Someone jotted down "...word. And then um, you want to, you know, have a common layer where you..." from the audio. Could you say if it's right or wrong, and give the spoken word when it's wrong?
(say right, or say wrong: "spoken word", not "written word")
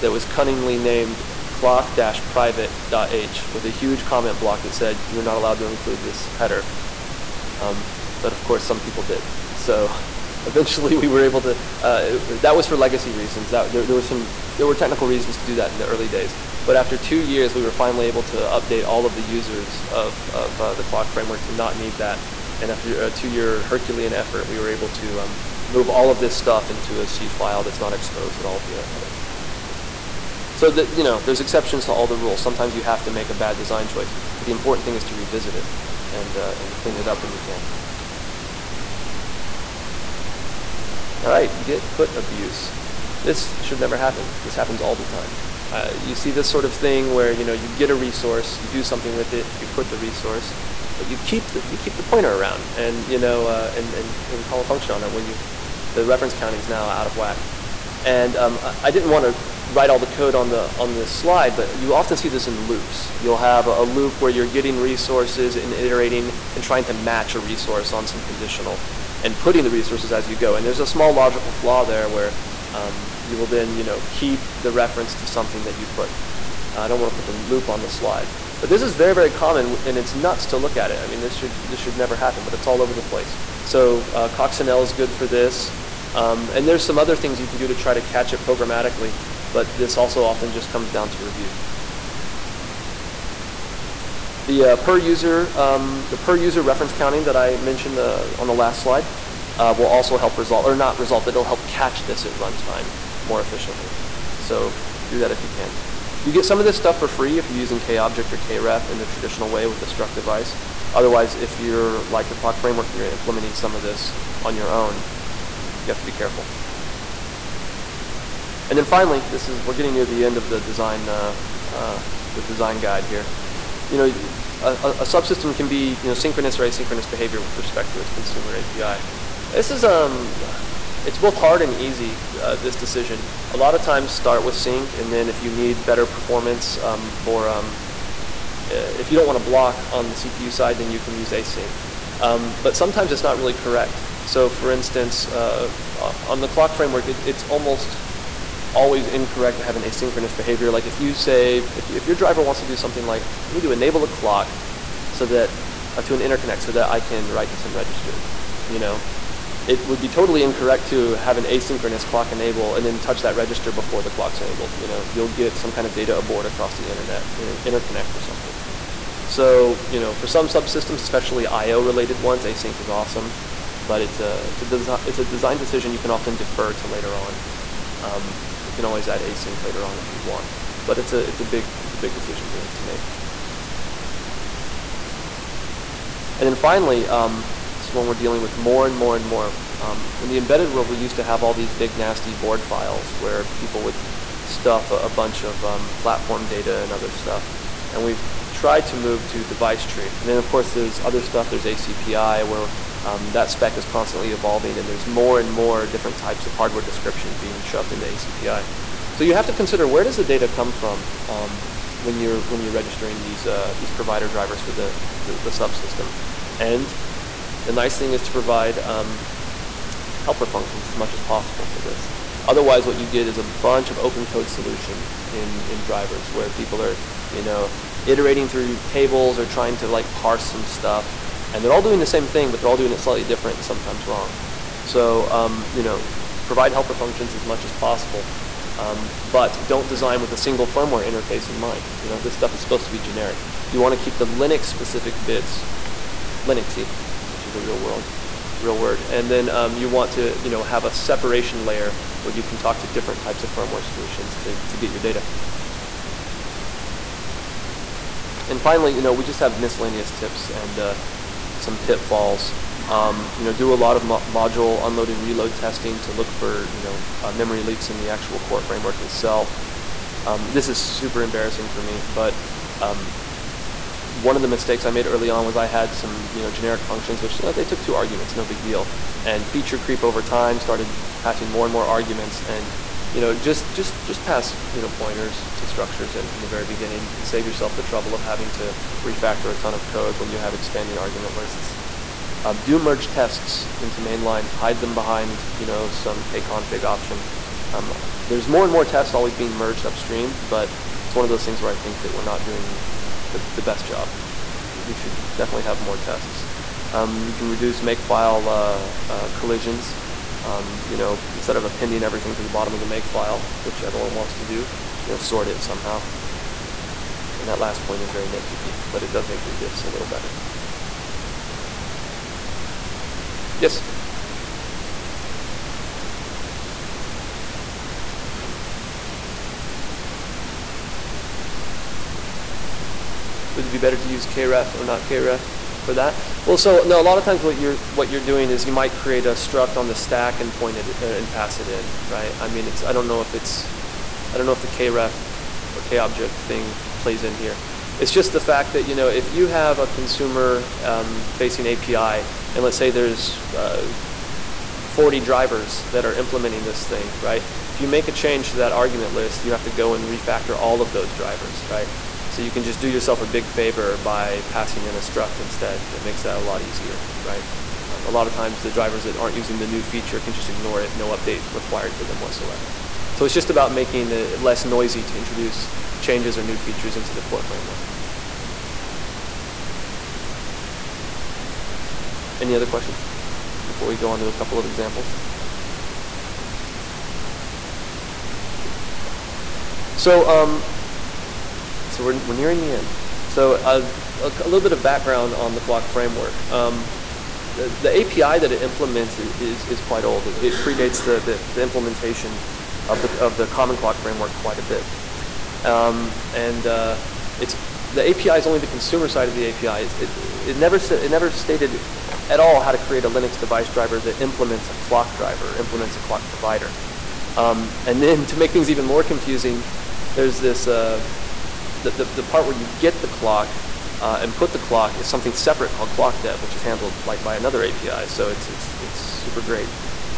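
wrong: "separation", not "common".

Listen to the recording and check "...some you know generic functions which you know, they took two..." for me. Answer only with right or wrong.
right.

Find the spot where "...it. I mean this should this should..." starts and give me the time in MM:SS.
01:20.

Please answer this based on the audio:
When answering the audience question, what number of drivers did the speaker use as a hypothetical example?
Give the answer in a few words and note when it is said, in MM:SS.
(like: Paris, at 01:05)
40, at 05:54.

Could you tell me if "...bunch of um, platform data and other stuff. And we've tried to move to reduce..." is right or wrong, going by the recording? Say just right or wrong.
wrong.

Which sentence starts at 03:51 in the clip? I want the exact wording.
And they're all doing the same thing, but they're all doing it slightly different and sometimes wrong.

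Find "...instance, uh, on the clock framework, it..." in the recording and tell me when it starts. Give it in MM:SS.
02:24.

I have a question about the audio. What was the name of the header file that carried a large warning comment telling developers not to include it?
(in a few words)
clock-private.h.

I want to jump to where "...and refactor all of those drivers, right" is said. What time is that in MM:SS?
05:59.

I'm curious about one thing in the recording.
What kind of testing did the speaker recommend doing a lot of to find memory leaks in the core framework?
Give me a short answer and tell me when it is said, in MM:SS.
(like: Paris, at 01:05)
module unload and reload, at 04:24.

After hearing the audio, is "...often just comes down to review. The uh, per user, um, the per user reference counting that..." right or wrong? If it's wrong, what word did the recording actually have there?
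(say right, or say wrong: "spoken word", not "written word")
right.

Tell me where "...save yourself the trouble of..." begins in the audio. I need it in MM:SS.
04:47.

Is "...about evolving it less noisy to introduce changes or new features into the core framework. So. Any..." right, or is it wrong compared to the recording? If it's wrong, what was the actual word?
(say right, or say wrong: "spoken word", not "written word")
wrong: "making", not "evolving".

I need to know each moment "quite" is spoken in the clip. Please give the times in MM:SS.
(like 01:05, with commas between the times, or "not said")
06:39, 06:44.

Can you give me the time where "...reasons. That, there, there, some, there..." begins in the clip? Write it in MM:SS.
00:13.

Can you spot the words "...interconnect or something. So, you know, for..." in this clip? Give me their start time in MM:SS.
02:47.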